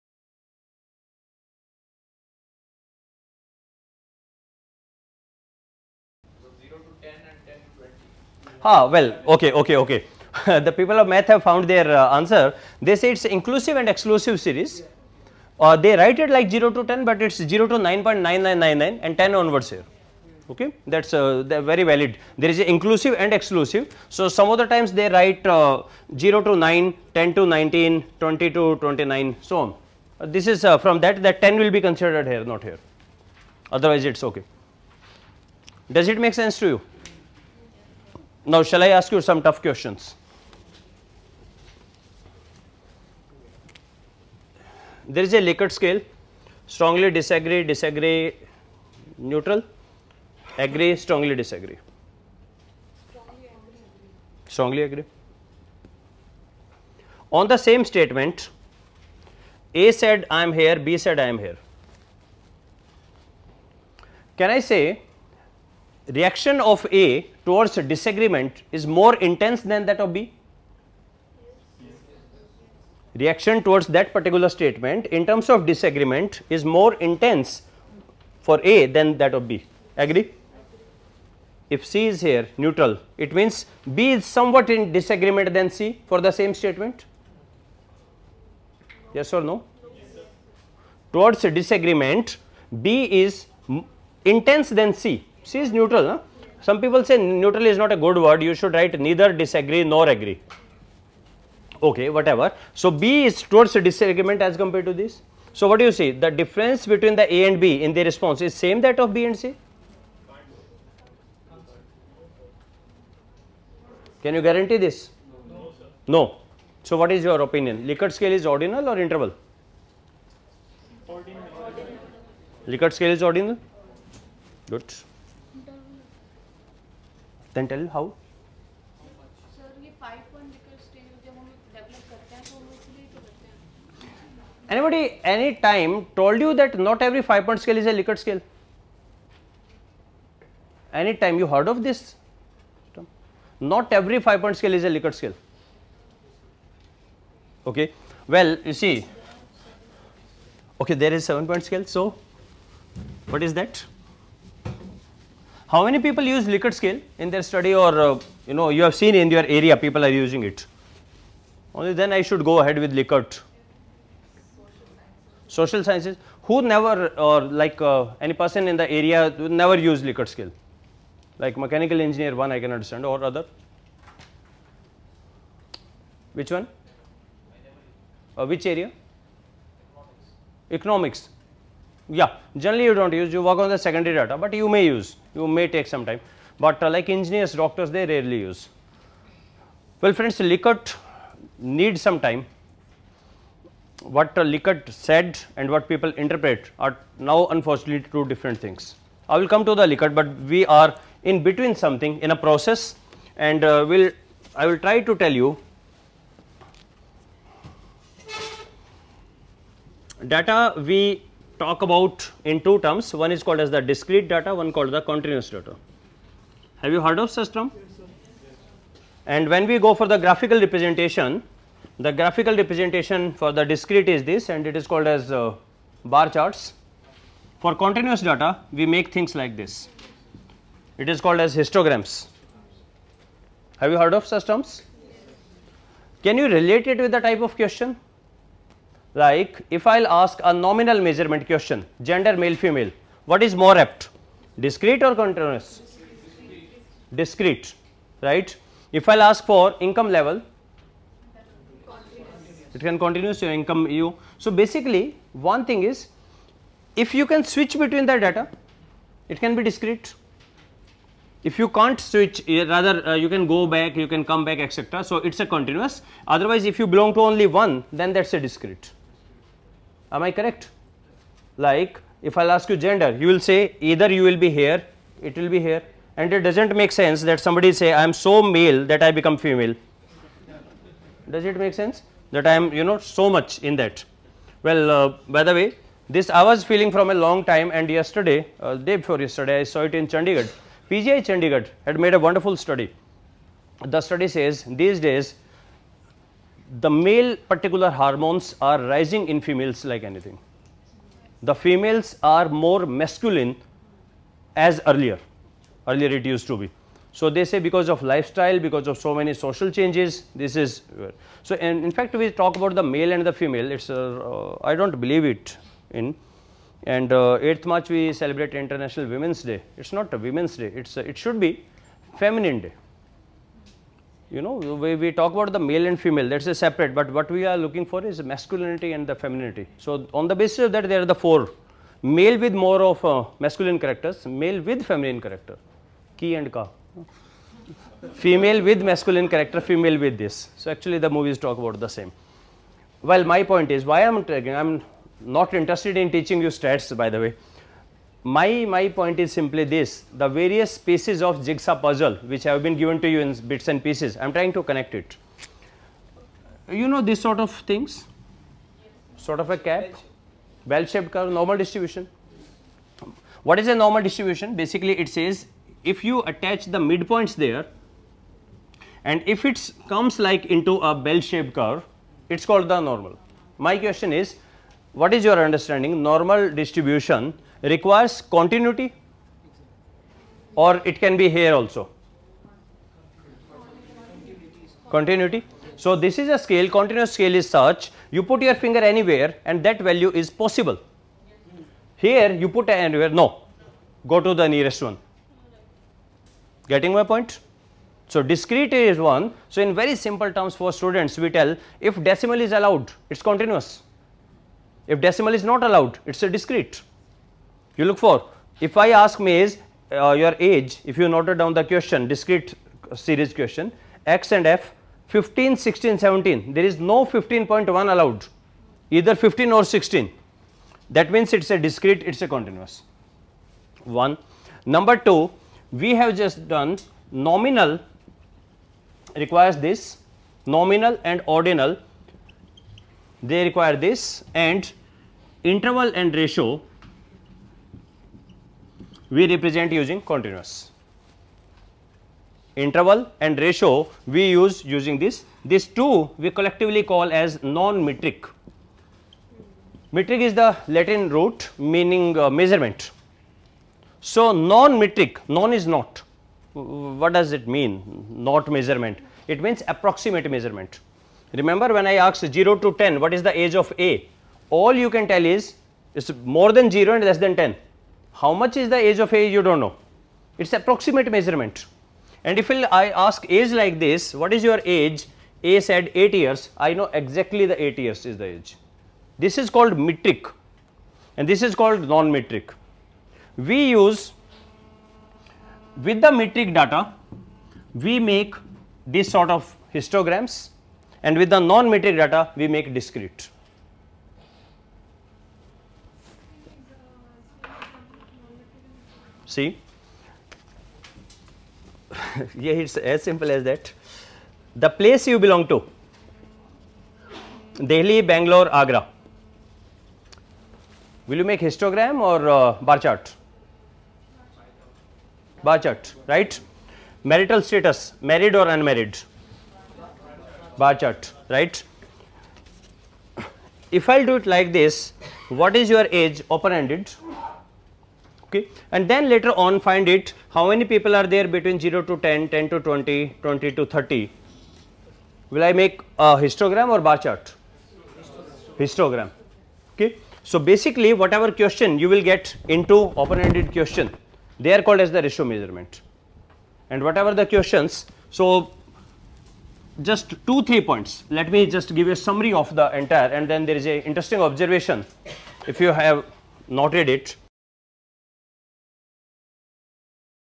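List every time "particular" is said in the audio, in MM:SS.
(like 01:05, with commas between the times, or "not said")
01:14, 04:57.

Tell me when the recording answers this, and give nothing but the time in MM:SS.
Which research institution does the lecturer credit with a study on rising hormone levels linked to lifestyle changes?
04:50.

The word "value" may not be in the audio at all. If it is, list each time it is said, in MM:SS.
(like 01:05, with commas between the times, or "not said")
06:29.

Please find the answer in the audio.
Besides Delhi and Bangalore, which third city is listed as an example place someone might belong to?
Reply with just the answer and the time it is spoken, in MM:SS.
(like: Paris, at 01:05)
Agra, at 08:28.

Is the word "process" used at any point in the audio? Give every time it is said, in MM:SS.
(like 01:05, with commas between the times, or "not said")
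03:22.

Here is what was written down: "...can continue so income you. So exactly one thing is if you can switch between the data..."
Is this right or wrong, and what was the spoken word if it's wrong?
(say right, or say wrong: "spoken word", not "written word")
wrong: "basically", not "exactly".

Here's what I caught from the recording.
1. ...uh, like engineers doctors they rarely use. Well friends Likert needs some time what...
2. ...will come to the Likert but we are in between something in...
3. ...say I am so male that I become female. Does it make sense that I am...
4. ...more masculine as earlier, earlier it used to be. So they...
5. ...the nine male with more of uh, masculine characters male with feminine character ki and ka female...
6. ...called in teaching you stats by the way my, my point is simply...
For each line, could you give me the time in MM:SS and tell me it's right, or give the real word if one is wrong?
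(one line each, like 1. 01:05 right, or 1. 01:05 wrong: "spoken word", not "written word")
1. 03:06 right
2. 03:19 right
3. 04:37 right
4. 05:02 right
5. 05:31 wrong: "four", not "nine"
6. 05:45 wrong: "interested", not "called".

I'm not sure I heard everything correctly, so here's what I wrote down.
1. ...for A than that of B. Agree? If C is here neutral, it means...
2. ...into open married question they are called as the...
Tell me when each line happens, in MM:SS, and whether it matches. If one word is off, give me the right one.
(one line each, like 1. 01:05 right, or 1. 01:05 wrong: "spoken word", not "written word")
1. 01:18 right
2. 09:02 wrong: "ended", not "married".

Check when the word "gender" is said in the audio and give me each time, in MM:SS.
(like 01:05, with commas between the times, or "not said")
04:02, 04:32.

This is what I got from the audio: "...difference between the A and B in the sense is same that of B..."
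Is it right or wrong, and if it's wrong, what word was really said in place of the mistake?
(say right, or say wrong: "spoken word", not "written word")
wrong: "response", not "sense".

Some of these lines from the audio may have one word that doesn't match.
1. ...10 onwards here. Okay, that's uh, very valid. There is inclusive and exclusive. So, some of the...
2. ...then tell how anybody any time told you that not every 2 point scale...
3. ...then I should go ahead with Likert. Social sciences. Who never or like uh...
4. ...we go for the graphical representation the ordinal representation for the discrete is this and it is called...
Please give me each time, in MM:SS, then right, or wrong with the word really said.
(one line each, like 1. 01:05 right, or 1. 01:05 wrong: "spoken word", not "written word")
1. 00:19 right
2. 02:07 wrong: "5", not "2"
3. 02:41 right
4. 03:39 wrong: "graphical", not "ordinal".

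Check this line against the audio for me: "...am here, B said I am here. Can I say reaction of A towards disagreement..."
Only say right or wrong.
right.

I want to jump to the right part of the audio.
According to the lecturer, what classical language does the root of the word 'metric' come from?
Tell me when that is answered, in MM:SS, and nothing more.
07:30.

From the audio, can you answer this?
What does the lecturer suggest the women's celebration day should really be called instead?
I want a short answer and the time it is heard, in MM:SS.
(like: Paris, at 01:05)
Feminine Day, at 05:22.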